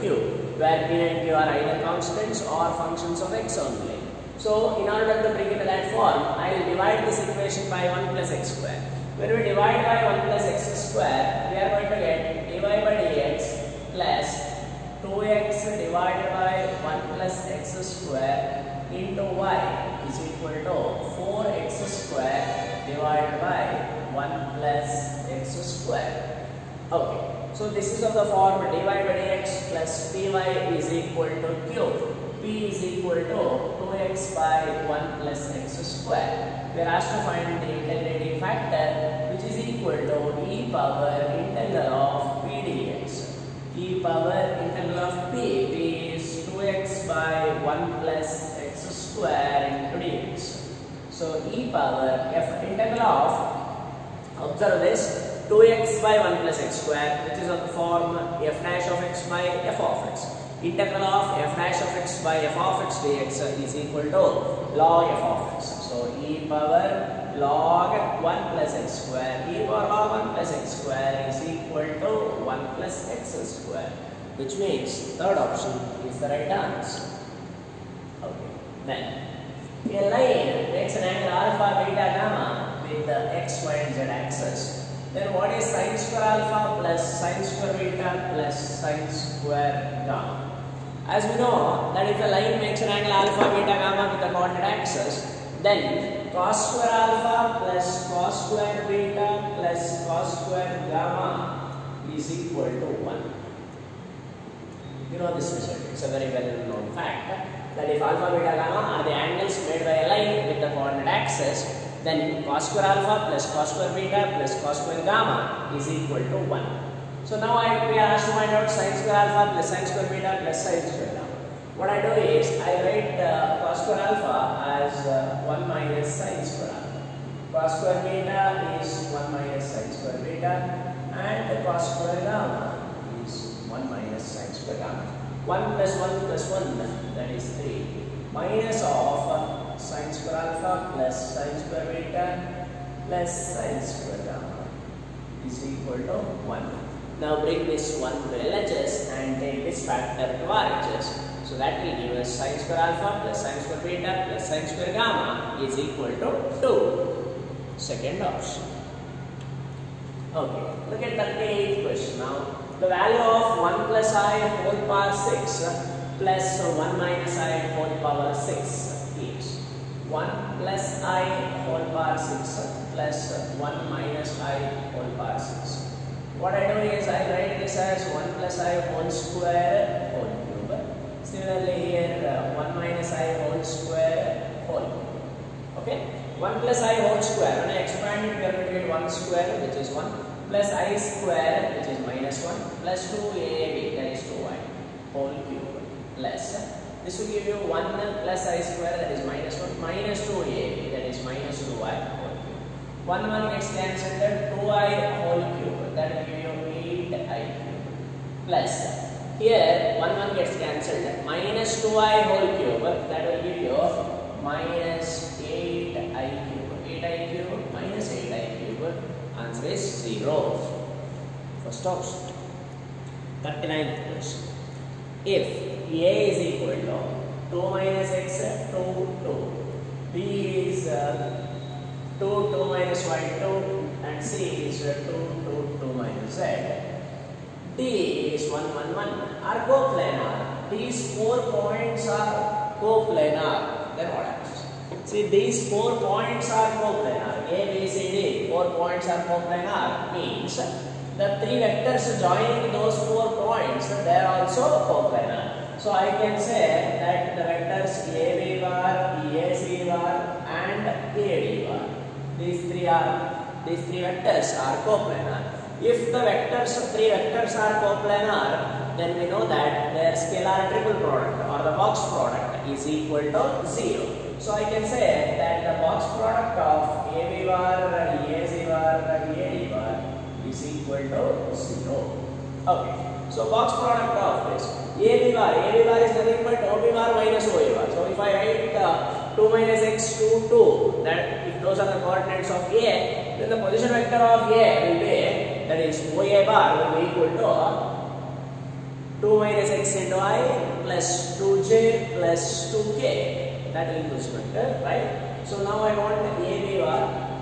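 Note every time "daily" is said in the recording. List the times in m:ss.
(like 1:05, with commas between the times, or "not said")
not said.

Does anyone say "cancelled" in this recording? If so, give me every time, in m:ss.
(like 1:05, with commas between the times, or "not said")
3:23, 3:30.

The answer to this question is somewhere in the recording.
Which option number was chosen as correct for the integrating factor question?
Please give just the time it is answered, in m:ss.
1:15.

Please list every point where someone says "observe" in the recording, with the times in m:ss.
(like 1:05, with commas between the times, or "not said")
0:54.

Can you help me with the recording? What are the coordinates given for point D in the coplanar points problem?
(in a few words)
1, 1, 1.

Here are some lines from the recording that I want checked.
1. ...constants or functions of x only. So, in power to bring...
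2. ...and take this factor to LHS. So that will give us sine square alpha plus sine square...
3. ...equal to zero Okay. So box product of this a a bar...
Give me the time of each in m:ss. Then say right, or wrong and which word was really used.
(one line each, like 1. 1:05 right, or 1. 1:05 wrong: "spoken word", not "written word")
1. 0:01 wrong: "order", not "power"
2. 2:29 wrong: "RHS", not "LHS"
3. 4:40 right.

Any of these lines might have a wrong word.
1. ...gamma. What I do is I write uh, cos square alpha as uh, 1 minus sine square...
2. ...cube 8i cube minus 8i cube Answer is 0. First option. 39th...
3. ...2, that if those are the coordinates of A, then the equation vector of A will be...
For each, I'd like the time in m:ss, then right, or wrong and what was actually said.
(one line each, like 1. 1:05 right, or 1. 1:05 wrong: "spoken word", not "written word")
1. 2:01 right
2. 3:36 right
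3. 4:50 wrong: "position", not "equation".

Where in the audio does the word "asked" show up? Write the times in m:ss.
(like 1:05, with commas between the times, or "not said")
0:36, 1:58.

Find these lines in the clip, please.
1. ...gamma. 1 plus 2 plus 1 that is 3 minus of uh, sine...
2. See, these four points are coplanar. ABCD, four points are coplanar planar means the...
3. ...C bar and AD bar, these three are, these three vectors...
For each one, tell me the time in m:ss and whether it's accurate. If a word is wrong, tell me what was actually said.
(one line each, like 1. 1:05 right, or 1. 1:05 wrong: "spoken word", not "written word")
1. 2:14 wrong: "1", not "2"
2. 4:05 right
3. 4:19 right.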